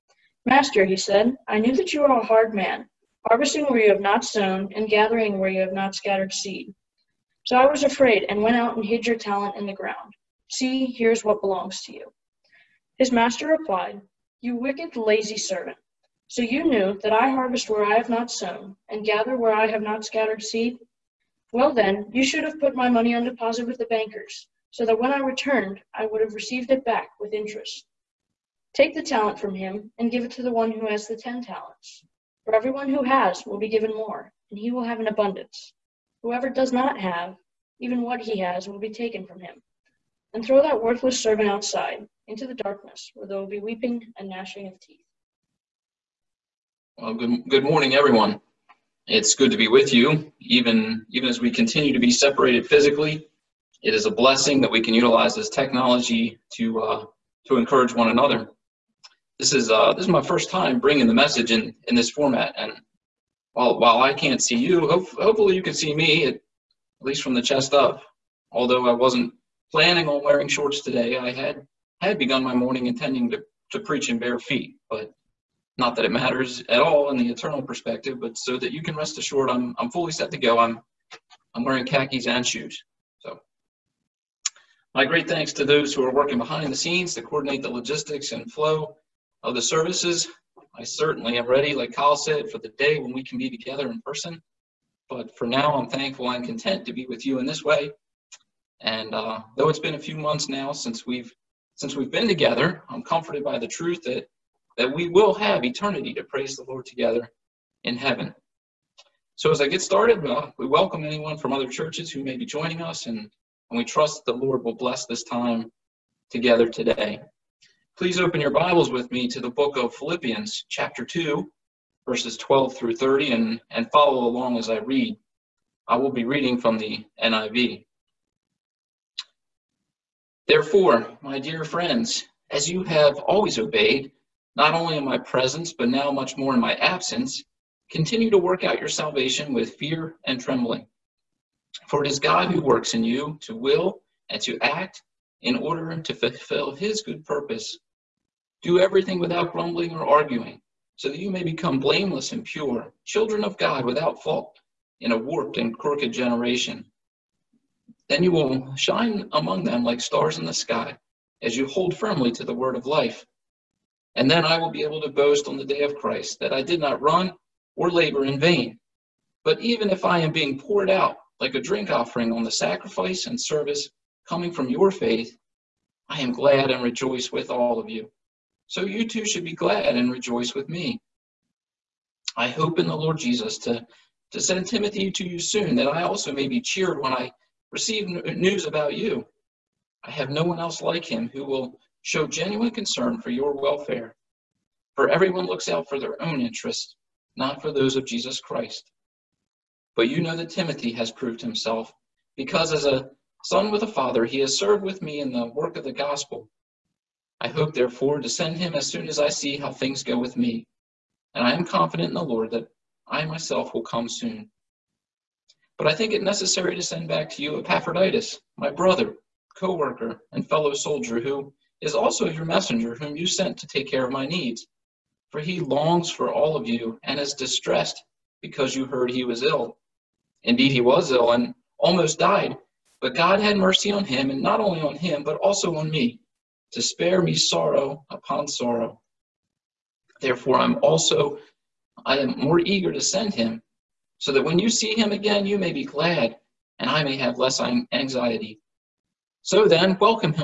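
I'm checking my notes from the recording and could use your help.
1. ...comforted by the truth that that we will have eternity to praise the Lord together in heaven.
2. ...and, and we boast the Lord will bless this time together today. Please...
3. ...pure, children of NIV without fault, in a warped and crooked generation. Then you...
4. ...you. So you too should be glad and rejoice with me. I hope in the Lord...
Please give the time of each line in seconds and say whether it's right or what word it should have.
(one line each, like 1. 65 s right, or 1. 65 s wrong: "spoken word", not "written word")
1. 103 s right
2. 113 s wrong: "trust", not "boast"
3. 152 s wrong: "God", not "NIV"
4. 177 s right.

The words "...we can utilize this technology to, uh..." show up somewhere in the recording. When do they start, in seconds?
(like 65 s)
54 s.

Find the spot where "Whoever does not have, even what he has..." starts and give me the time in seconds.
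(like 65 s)
36 s.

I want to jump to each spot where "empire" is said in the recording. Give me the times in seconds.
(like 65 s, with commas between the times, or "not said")
not said.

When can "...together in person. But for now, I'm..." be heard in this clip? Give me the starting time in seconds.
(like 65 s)
93 s.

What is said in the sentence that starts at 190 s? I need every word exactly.
I have no one else like him who will show genuine concern for your welfare.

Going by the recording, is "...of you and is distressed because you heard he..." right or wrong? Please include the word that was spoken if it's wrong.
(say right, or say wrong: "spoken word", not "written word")
right.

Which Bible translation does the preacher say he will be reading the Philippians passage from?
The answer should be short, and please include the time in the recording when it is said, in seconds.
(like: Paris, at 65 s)
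NIV, at 127 s.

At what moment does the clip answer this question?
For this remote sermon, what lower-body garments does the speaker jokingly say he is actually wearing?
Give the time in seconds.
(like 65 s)
81 s.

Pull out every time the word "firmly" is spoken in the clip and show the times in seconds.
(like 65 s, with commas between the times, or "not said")
161 s.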